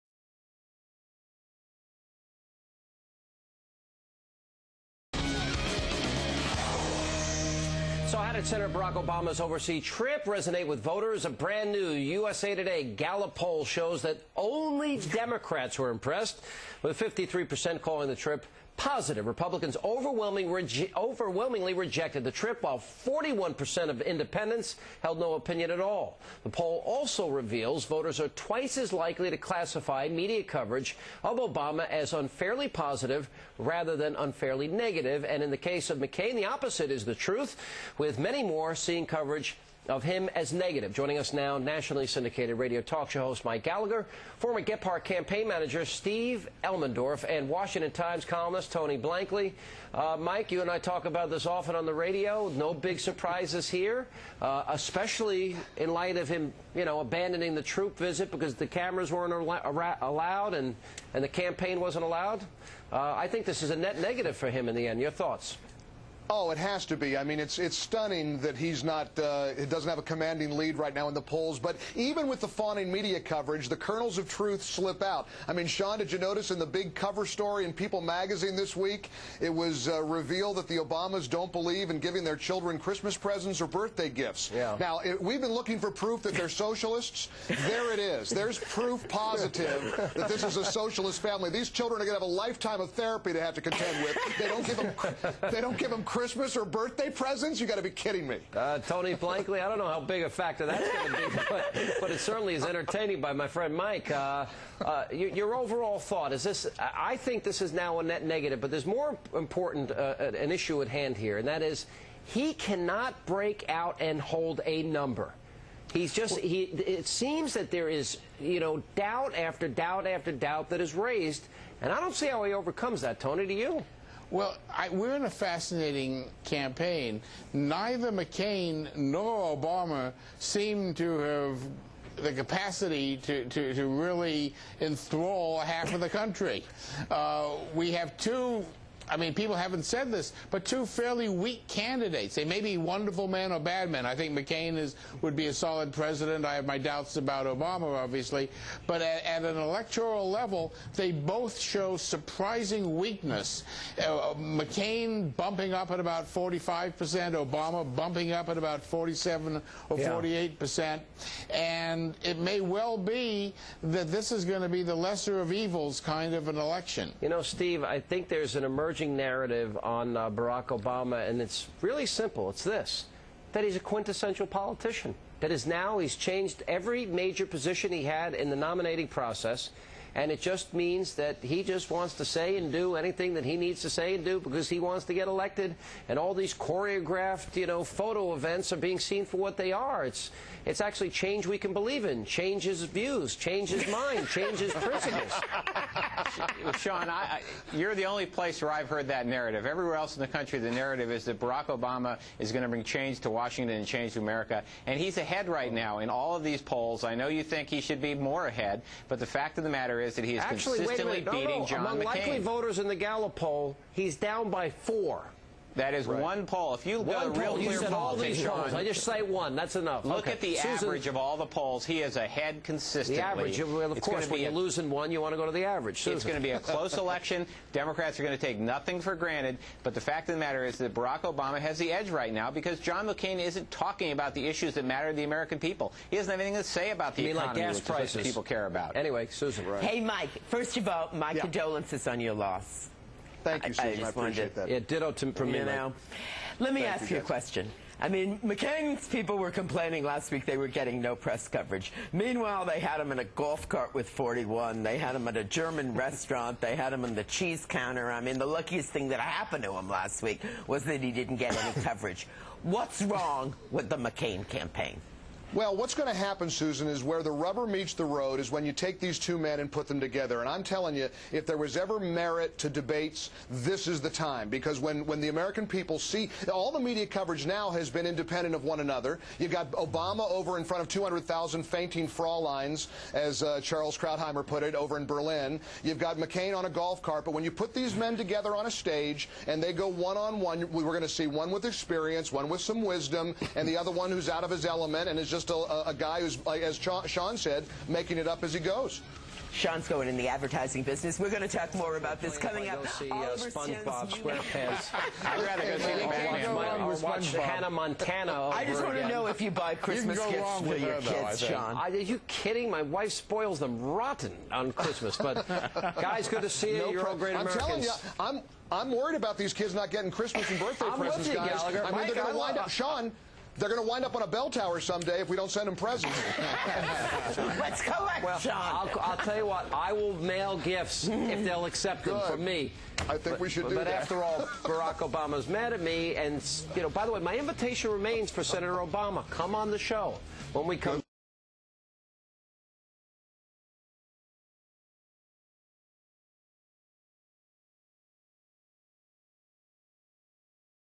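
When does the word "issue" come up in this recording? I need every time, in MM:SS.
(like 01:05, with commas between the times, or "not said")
01:50, 03:54.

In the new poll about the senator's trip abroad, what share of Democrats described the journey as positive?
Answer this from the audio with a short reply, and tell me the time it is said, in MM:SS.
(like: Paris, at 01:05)
53%, at 00:16.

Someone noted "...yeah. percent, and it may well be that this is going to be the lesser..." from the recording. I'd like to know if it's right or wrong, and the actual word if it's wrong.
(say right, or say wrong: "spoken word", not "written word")
right.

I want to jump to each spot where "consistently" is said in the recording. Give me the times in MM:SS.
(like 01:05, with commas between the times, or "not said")
03:30, 03:42.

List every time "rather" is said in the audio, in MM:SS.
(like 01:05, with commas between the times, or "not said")
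00:33, 05:05.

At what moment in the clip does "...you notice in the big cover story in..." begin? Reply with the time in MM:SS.
01:16.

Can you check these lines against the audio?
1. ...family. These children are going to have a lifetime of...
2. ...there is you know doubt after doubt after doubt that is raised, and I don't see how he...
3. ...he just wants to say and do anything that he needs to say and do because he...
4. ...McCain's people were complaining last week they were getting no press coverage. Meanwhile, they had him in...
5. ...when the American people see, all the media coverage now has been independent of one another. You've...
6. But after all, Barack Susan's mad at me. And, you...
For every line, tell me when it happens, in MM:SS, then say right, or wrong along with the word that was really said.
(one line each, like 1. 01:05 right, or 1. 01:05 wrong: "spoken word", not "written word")
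1. 01:31 right
2. 01:57 right
3. 03:01 right
4. 04:08 right
5. 04:35 right
6. 05:33 wrong: "Obama", not "Susan".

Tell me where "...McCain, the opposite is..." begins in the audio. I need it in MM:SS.
00:35.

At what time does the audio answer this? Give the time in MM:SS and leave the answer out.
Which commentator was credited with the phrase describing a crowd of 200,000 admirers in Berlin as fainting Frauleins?
04:43.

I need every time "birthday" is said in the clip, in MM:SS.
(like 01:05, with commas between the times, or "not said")
01:23, 01:36, 05:20.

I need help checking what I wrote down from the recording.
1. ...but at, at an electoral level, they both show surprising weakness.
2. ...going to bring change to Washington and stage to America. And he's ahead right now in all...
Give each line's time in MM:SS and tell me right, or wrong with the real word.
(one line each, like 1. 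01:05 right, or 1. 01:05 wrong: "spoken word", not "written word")
1. 02:28 right
2. 03:22 wrong: "change", not "stage".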